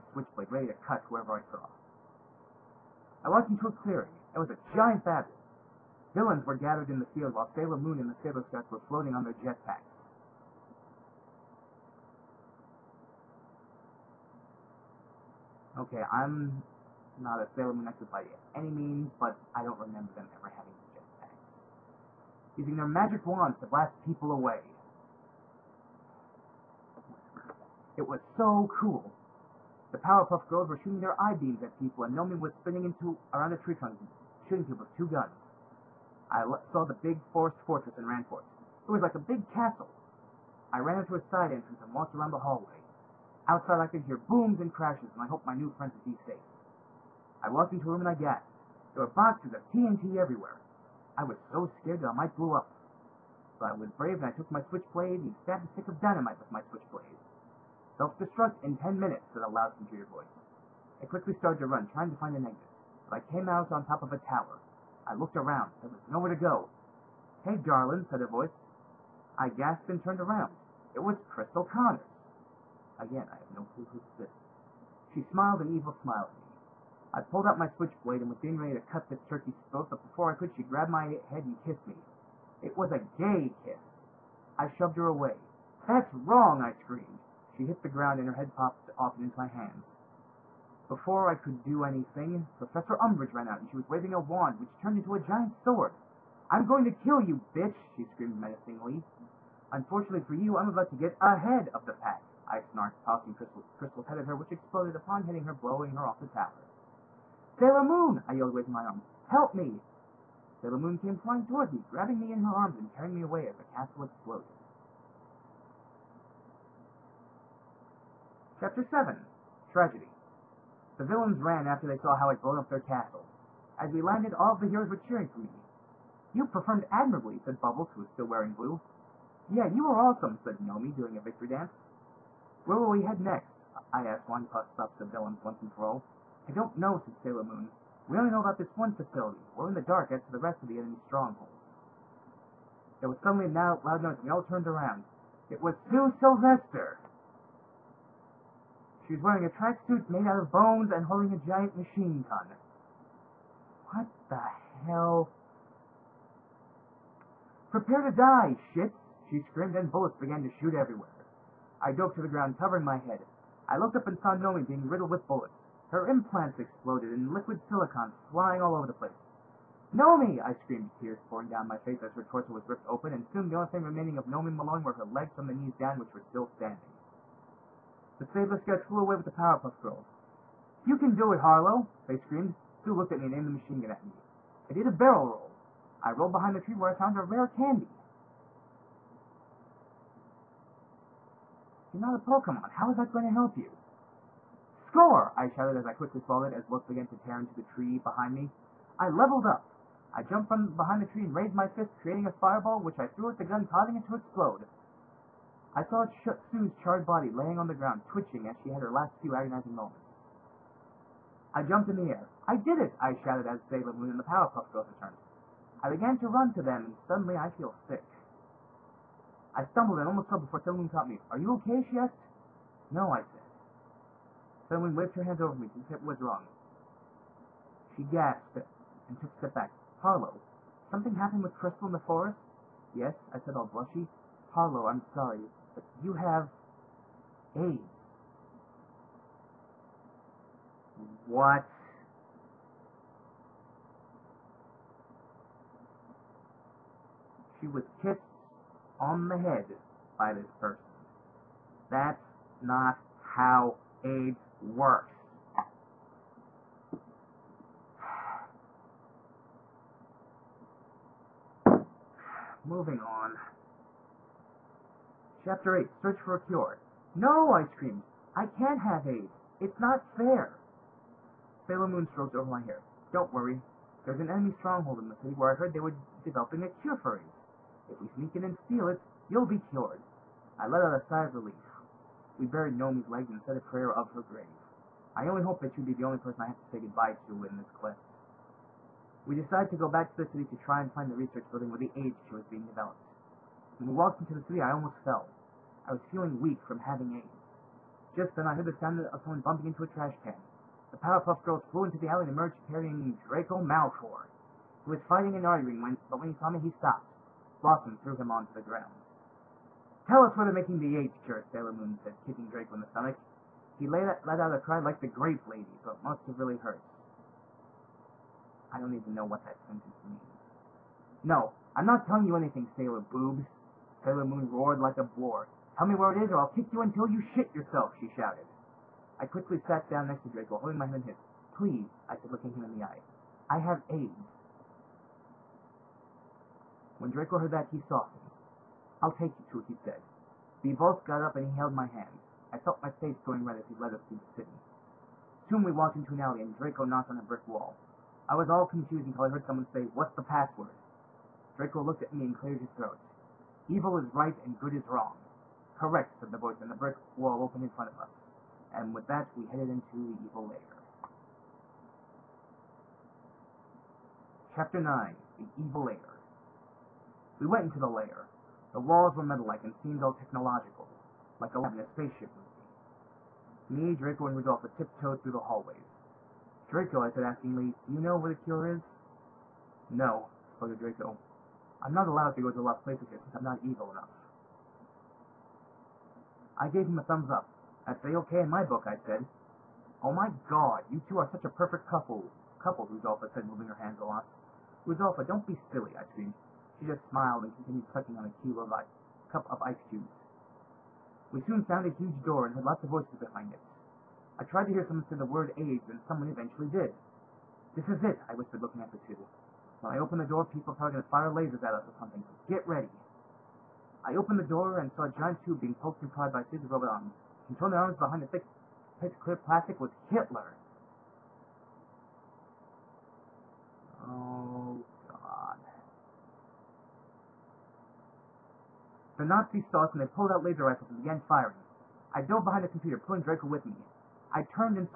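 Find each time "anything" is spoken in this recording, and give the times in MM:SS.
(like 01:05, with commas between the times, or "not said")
01:31, 05:22.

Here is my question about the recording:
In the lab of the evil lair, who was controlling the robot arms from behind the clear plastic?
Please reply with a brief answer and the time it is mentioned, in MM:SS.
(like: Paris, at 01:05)
Hitler, at 06:59.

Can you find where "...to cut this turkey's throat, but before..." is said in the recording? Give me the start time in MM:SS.
01:18.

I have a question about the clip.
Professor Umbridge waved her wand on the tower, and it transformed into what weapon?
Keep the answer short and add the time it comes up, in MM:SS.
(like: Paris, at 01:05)
Giant sword, at 01:35.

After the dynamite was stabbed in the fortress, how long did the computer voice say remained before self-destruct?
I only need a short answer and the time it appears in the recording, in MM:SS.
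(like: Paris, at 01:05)
10 minutes, at 00:58.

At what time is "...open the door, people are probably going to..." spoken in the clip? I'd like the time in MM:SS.
06:49.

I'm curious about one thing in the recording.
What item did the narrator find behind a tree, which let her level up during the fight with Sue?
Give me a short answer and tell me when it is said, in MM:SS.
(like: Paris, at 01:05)
Rare candy, at 03:07.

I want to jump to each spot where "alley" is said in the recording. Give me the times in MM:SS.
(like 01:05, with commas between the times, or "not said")
05:02, 05:46.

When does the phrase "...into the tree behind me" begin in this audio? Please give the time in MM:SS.
03:17.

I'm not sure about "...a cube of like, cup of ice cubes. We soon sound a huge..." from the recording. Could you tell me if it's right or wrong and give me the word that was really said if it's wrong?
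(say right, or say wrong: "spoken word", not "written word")
wrong: "found", not "sound".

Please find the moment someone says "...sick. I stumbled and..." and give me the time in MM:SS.
03:37.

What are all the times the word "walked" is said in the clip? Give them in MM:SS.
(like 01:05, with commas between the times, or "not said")
00:03, 00:41, 00:47, 04:53, 05:45.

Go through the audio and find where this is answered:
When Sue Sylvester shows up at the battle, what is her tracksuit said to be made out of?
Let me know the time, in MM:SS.
02:30.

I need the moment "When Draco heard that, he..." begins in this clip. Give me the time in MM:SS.
05:37.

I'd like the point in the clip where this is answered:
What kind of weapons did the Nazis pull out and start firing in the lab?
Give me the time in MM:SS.
07:10.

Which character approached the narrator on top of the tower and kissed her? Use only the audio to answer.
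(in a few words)
Crystal Connors.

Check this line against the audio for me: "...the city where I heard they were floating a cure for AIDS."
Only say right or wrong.
wrong.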